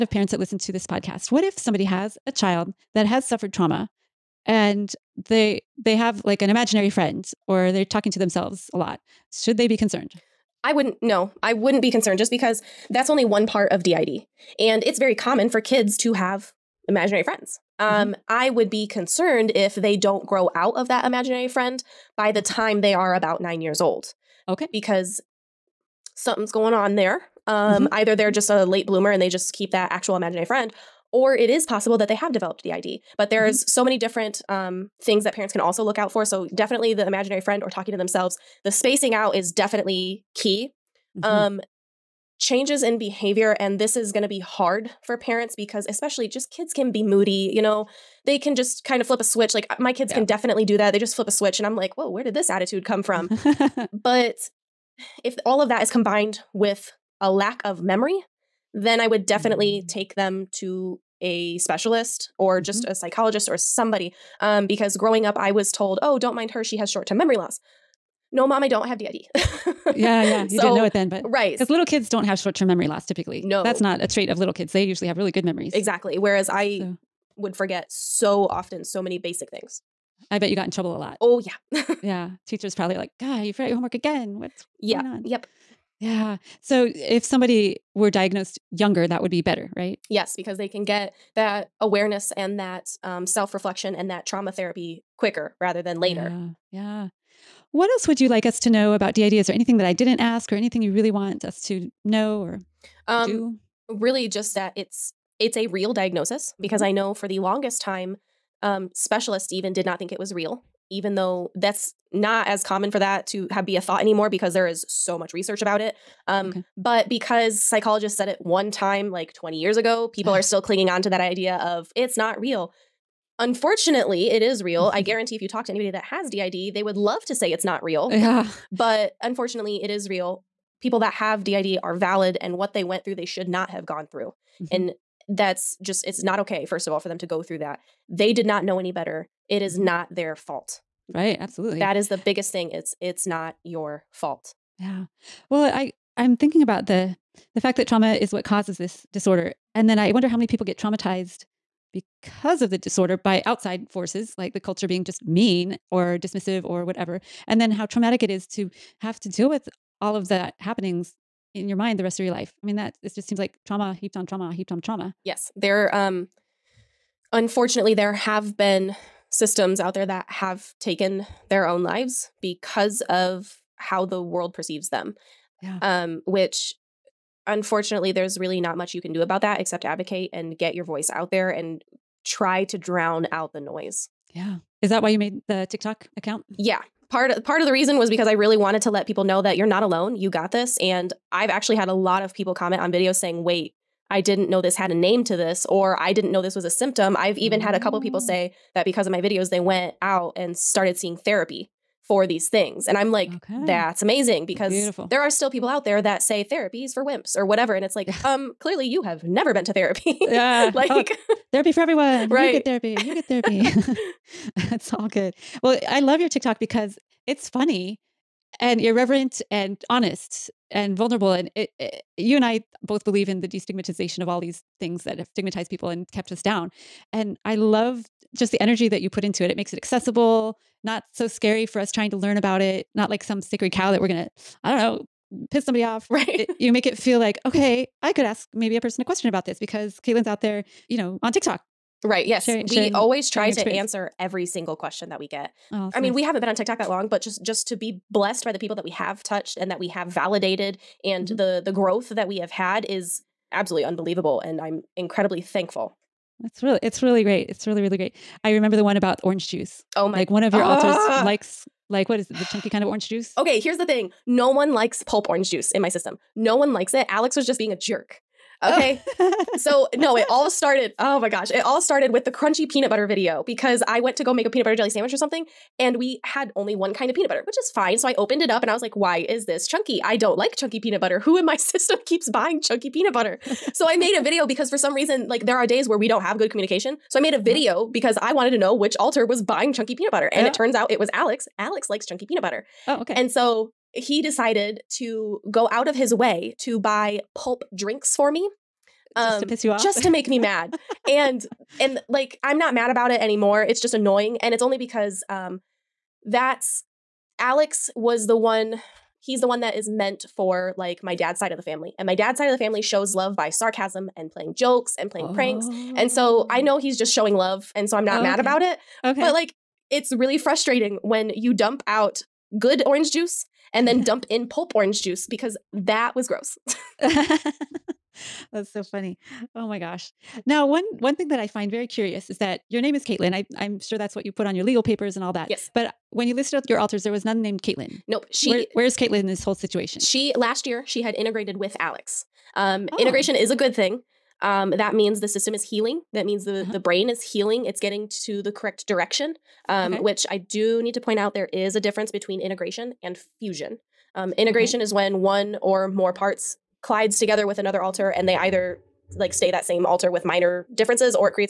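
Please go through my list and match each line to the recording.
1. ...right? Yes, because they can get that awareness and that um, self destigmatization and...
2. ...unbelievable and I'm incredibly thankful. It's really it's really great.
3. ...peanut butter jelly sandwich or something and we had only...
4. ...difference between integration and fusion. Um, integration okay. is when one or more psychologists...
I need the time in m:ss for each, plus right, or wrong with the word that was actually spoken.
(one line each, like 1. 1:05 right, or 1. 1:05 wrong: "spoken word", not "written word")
1. 1:29 wrong: "reflection", not "destigmatization"
2. 4:13 right
3. 4:34 right
4. 5:51 wrong: "parts", not "psychologists".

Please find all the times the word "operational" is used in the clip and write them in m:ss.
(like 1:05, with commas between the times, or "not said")
not said.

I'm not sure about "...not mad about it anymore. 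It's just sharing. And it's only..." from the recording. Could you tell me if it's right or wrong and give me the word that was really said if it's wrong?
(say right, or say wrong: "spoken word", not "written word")
wrong: "annoying", not "sharing".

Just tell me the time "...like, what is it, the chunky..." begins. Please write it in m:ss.
4:21.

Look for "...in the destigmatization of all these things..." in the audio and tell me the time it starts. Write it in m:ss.
3:43.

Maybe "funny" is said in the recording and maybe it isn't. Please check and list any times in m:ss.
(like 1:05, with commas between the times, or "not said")
3:37, 5:28.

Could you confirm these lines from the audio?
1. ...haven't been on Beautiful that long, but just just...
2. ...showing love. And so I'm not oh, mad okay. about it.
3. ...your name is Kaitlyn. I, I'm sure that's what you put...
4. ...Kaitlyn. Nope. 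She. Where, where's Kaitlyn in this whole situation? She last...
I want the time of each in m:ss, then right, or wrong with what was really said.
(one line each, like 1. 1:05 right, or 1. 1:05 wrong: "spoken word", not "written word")
1. 4:06 wrong: "TikTok", not "Beautiful"
2. 5:17 right
3. 5:32 right
4. 5:37 right.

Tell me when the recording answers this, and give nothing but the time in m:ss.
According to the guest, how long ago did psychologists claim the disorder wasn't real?
1:59.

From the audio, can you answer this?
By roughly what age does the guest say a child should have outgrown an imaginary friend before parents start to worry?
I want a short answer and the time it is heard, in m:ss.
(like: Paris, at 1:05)
9, at 0:23.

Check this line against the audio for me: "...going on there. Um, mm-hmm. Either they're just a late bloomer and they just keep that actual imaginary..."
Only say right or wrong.
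right.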